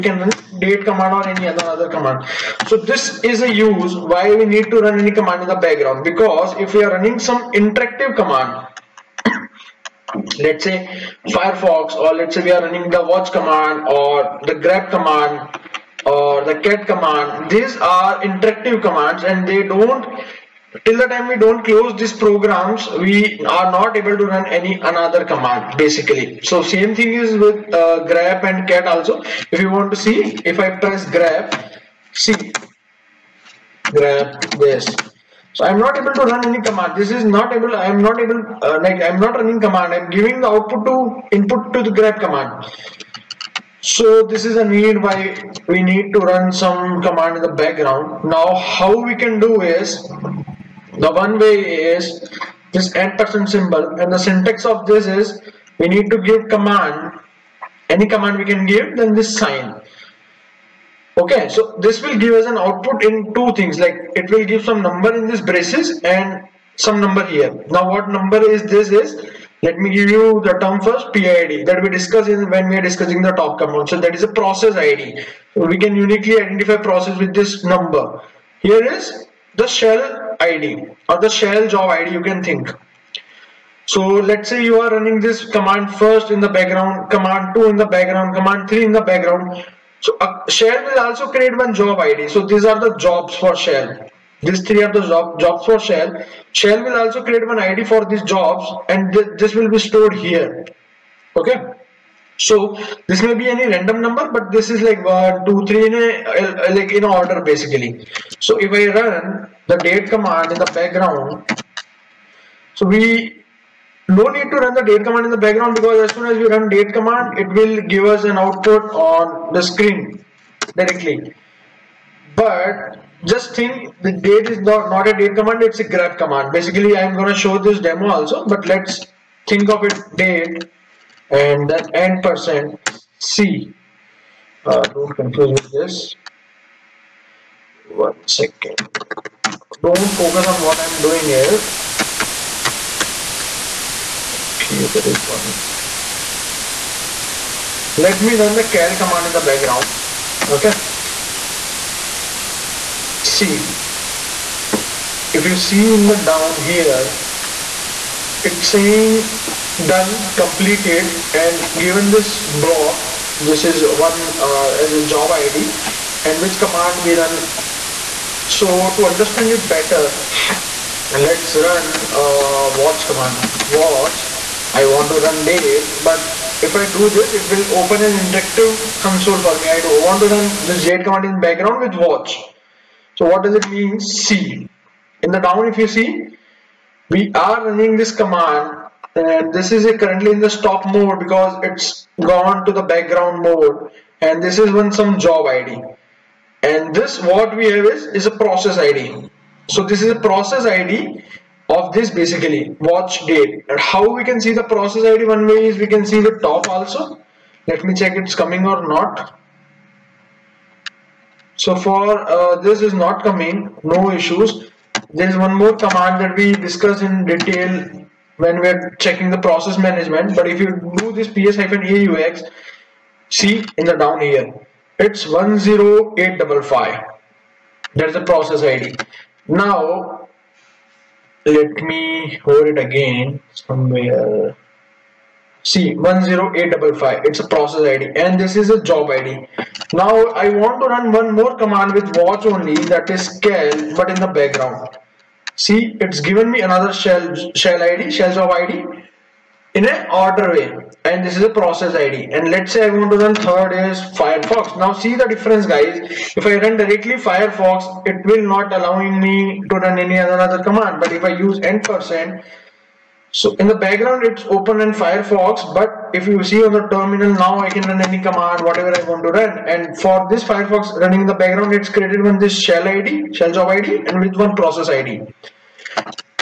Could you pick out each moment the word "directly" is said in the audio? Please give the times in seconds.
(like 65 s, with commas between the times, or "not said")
120 s, 256 s.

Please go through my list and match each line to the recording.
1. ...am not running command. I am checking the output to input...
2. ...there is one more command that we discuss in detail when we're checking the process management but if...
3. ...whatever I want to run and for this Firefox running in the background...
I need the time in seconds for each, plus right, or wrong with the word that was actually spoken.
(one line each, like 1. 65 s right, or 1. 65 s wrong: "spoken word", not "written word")
1. 39 s wrong: "giving", not "checking"
2. 215 s right
3. 268 s right.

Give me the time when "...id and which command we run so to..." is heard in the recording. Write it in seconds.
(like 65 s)
165 s.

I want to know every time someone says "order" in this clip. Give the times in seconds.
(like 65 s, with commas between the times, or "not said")
107 s, 250 s.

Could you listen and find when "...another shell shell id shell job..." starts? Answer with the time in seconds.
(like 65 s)
246 s.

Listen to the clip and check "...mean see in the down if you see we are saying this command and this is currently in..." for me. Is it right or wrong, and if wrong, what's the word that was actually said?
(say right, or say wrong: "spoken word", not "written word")
wrong: "running", not "saying".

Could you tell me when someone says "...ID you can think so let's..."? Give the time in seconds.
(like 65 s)
81 s.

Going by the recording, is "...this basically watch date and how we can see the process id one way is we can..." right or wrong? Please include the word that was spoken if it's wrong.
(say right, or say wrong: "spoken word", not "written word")
right.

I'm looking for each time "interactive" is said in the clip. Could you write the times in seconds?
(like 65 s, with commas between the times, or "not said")
7 s, 18 s, 178 s.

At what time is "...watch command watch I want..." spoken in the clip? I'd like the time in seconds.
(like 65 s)
172 s.